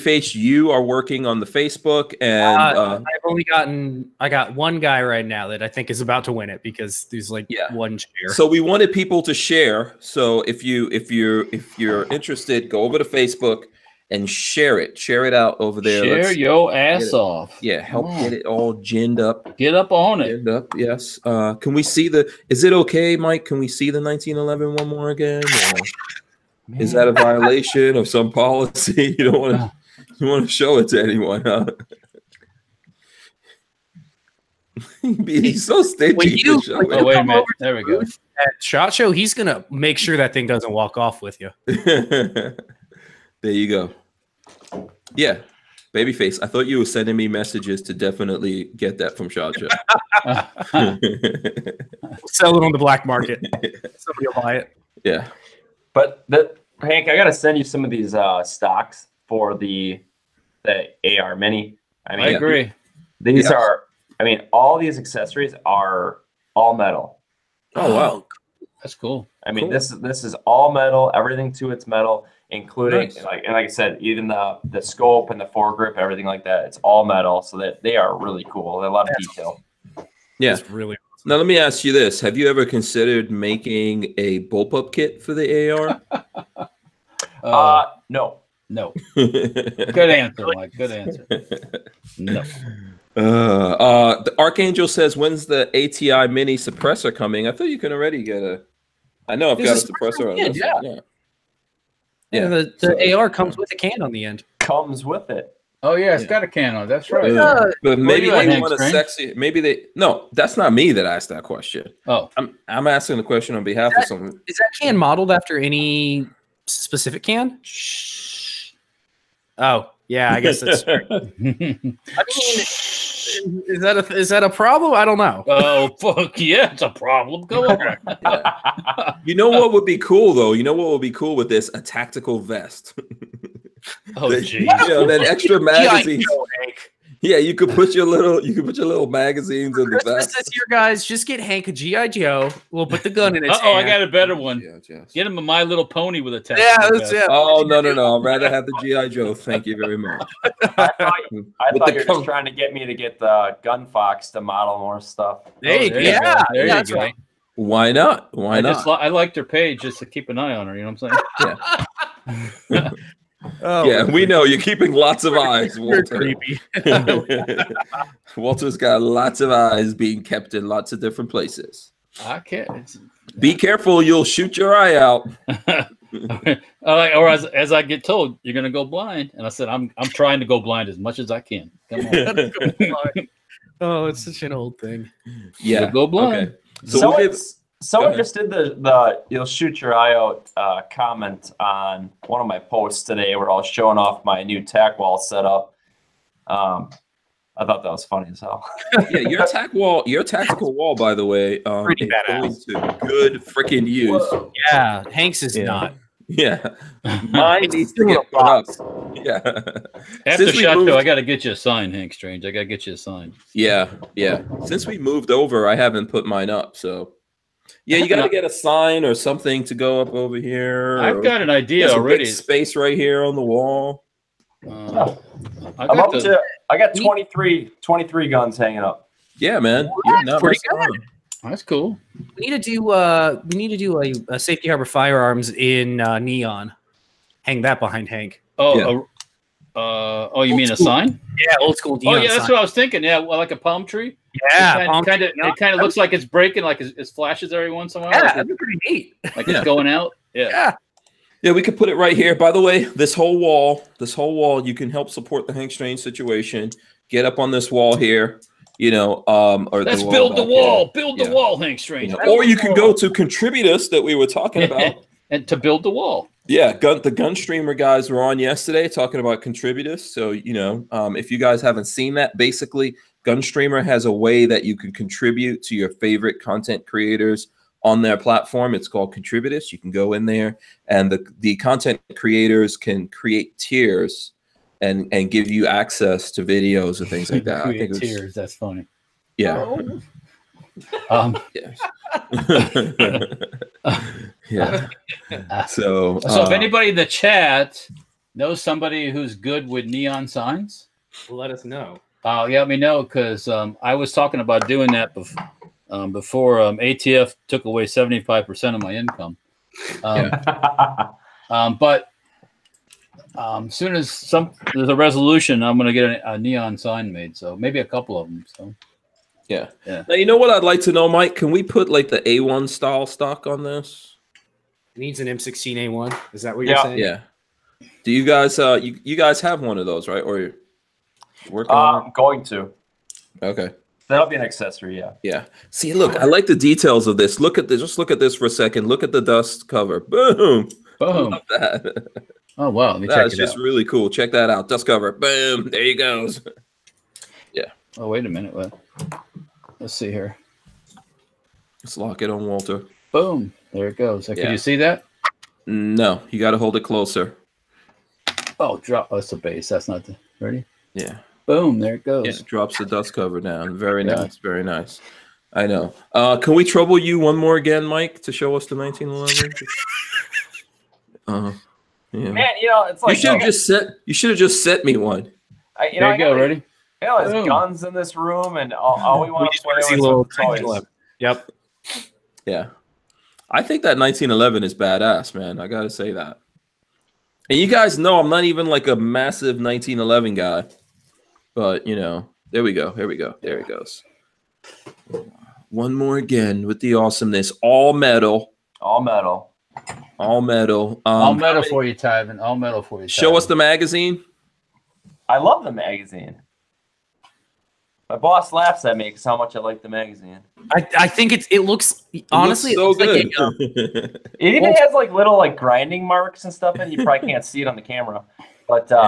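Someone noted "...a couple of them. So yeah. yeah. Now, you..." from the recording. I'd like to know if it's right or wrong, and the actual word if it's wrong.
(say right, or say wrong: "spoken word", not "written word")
right.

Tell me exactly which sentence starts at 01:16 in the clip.
It's all metal, so that they are really cool.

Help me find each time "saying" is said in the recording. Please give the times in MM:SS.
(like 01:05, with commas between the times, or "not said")
02:41, 05:26.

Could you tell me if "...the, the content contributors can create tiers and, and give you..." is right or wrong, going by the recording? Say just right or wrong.
wrong.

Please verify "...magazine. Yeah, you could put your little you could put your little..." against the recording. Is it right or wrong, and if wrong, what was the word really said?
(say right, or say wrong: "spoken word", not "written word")
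right.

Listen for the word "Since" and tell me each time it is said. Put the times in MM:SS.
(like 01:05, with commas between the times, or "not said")
03:30, 03:34.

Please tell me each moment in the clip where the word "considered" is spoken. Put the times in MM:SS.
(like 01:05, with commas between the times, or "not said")
01:22.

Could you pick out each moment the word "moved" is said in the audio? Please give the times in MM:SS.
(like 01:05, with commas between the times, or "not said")
03:30, 03:34.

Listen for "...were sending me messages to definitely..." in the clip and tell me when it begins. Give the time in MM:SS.
00:46.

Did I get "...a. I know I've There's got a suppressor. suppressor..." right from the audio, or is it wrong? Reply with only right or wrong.
right.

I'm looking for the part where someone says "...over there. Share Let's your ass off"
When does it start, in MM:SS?
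00:15.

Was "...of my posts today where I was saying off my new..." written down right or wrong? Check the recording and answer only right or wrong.
wrong.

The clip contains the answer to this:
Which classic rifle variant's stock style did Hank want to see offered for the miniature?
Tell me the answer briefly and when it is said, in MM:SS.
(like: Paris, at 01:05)
M16A1, at 05:25.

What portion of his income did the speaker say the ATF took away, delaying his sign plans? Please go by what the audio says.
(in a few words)
75%.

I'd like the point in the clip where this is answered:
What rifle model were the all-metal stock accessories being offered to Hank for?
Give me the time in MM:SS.
01:01.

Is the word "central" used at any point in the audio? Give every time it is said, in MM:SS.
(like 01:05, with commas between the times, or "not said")
not said.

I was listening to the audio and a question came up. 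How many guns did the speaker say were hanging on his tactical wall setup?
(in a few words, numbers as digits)
23.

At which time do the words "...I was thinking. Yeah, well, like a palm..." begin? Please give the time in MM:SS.
04:02.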